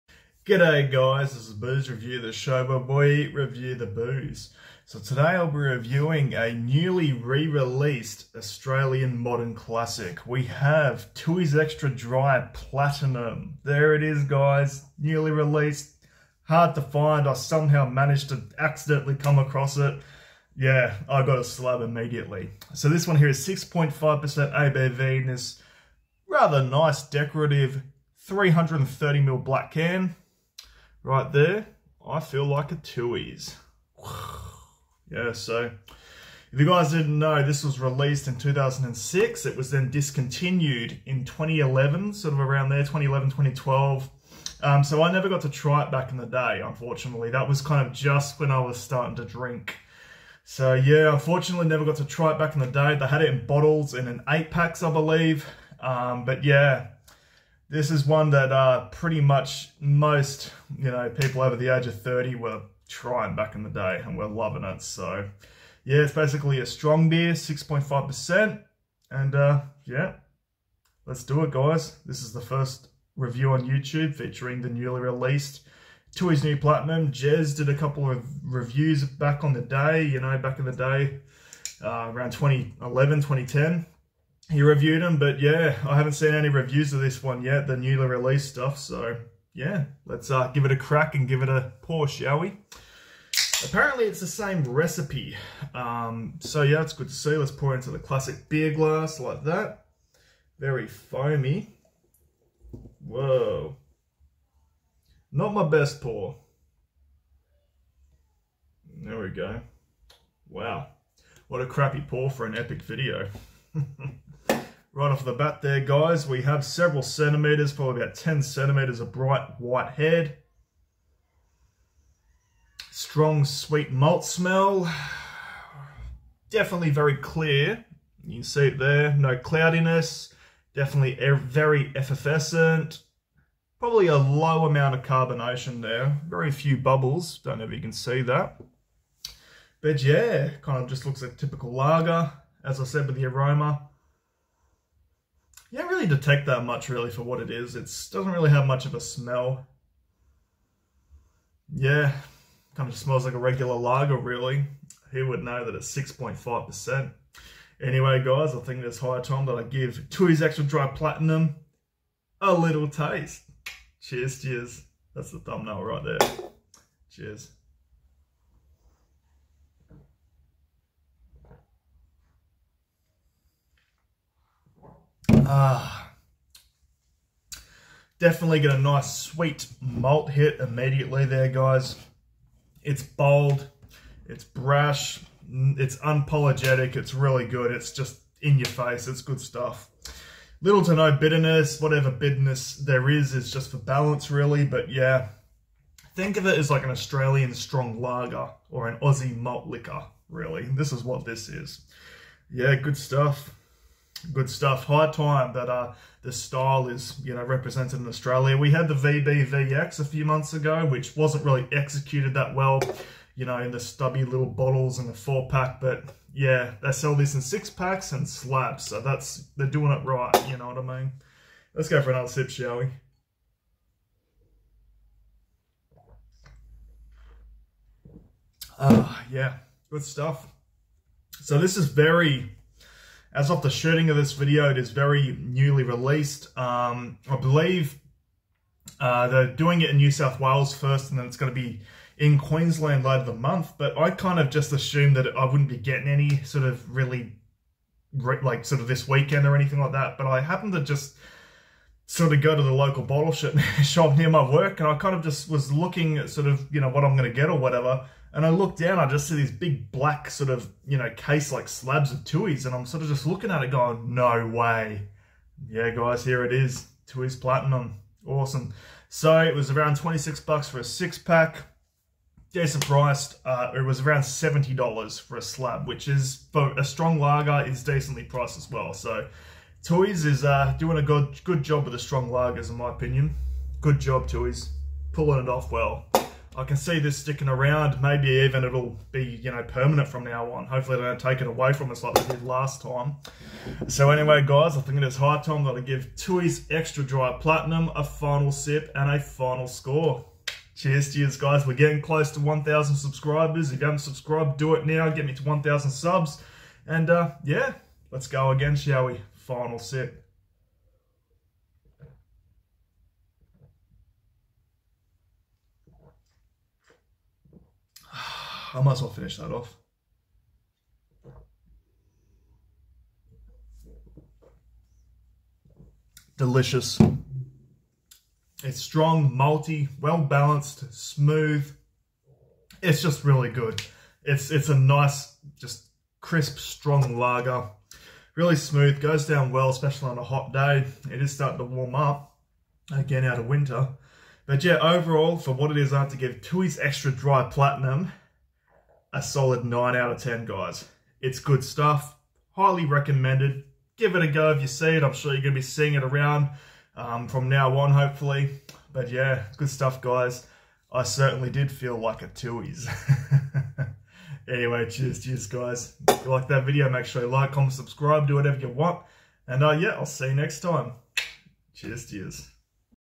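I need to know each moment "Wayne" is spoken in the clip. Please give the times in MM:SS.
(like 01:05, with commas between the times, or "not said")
not said.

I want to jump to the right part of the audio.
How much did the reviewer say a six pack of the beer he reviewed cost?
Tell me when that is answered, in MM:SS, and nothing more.
04:29.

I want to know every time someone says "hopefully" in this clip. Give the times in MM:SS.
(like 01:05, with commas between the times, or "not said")
04:50, 05:57.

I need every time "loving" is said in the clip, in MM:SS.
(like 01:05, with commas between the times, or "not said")
01:04.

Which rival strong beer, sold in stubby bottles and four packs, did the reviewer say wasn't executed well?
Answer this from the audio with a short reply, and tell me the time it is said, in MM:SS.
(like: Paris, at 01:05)
VB VX, at 03:28.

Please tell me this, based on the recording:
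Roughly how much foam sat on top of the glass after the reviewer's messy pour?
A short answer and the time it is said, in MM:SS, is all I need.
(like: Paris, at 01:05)
10 centimetres, at 01:58.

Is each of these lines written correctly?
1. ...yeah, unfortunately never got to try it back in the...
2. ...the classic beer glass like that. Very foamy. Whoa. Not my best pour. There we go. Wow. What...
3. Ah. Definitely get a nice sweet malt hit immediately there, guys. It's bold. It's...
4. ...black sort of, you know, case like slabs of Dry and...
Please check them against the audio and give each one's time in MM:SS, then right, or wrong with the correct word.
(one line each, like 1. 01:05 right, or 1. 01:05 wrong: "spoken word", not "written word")
1. 00:50 right
2. 01:37 right
3. 02:55 right
4. 04:19 wrong: "Tooheys", not "Dry".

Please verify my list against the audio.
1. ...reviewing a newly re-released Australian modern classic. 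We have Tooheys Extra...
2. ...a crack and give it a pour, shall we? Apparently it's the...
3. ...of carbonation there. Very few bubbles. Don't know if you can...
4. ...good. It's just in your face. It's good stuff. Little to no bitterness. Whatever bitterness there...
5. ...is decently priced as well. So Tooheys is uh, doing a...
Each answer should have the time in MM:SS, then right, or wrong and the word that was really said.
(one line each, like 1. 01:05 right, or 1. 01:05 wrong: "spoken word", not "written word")
1. 00:05 right
2. 01:30 right
3. 02:14 right
4. 03:07 right
5. 04:37 right.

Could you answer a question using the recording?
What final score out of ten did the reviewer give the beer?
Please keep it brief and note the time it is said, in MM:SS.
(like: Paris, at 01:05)
9, at 05:49.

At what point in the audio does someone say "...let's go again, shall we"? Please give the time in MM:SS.
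05:08.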